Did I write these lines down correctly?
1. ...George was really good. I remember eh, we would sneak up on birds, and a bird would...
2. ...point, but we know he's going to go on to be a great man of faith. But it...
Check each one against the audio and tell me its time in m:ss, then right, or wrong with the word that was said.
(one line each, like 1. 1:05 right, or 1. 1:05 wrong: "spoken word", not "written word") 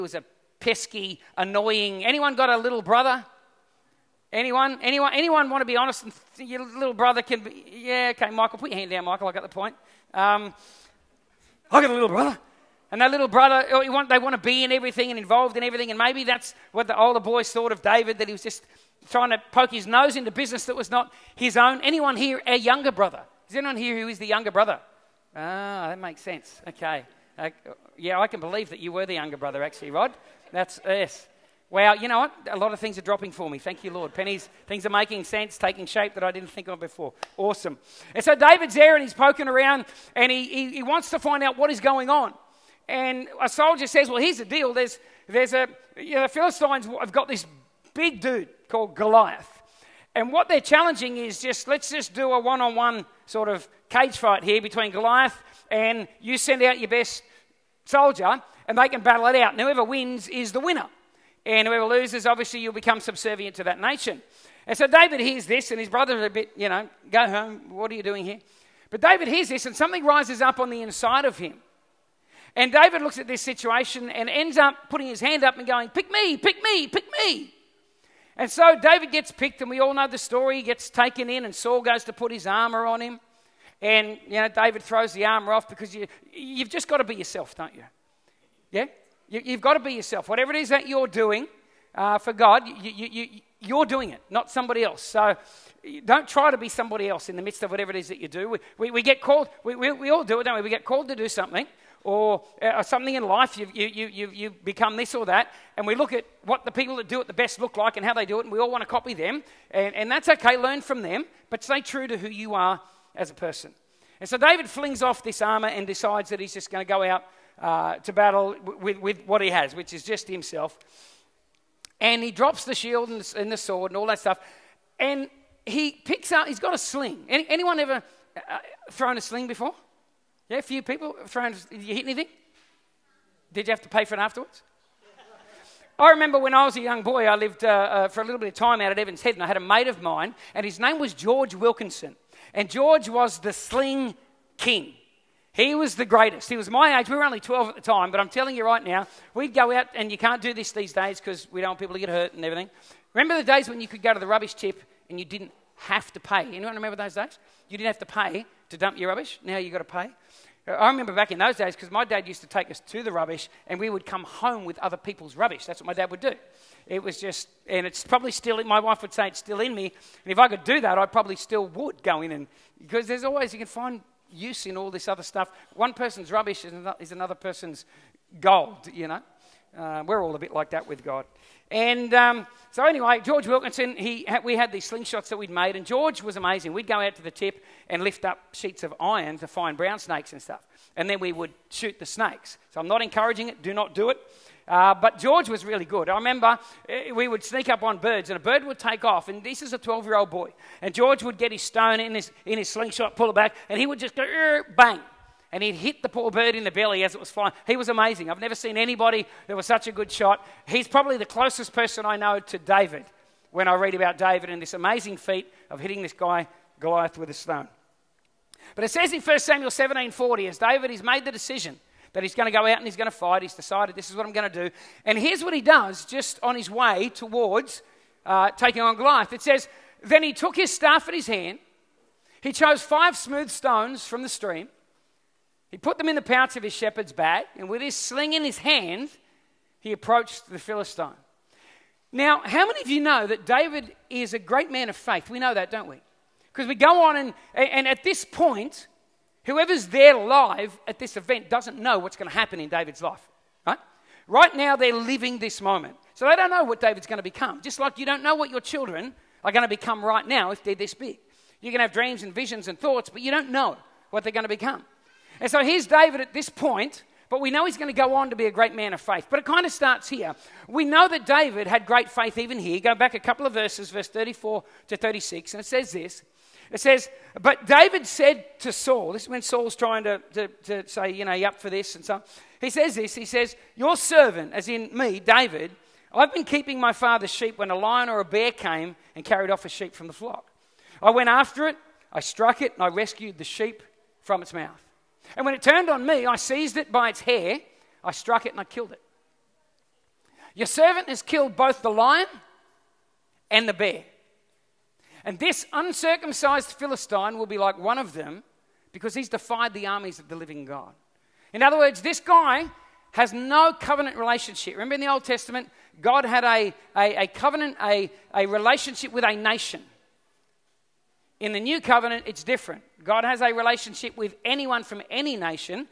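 1. 3:15 right
2. 4:26 right.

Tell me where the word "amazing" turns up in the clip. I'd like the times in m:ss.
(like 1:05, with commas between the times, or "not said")
3:06, 3:27, 3:34.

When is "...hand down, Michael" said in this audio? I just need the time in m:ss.
0:08.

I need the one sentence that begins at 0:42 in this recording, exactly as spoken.
And a soldier says, Well, here's the deal.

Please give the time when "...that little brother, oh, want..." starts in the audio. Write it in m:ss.
0:13.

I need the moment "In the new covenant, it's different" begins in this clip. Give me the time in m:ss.
5:21.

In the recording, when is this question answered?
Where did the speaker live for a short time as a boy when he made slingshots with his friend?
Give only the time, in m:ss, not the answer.
2:18.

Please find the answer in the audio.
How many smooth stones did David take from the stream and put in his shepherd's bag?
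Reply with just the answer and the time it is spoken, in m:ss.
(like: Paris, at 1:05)
5, at 3:52.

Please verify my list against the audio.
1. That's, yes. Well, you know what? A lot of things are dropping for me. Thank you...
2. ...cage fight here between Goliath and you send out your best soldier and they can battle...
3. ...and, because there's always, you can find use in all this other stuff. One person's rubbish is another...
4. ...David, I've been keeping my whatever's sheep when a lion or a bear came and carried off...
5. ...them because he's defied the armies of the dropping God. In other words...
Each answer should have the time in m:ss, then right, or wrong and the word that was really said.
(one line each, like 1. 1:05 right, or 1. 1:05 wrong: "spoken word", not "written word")
1. 0:30 right
2. 0:53 right
3. 2:52 right
4. 4:45 wrong: "father", not "whatever"
5. 5:08 wrong: "living", not "dropping".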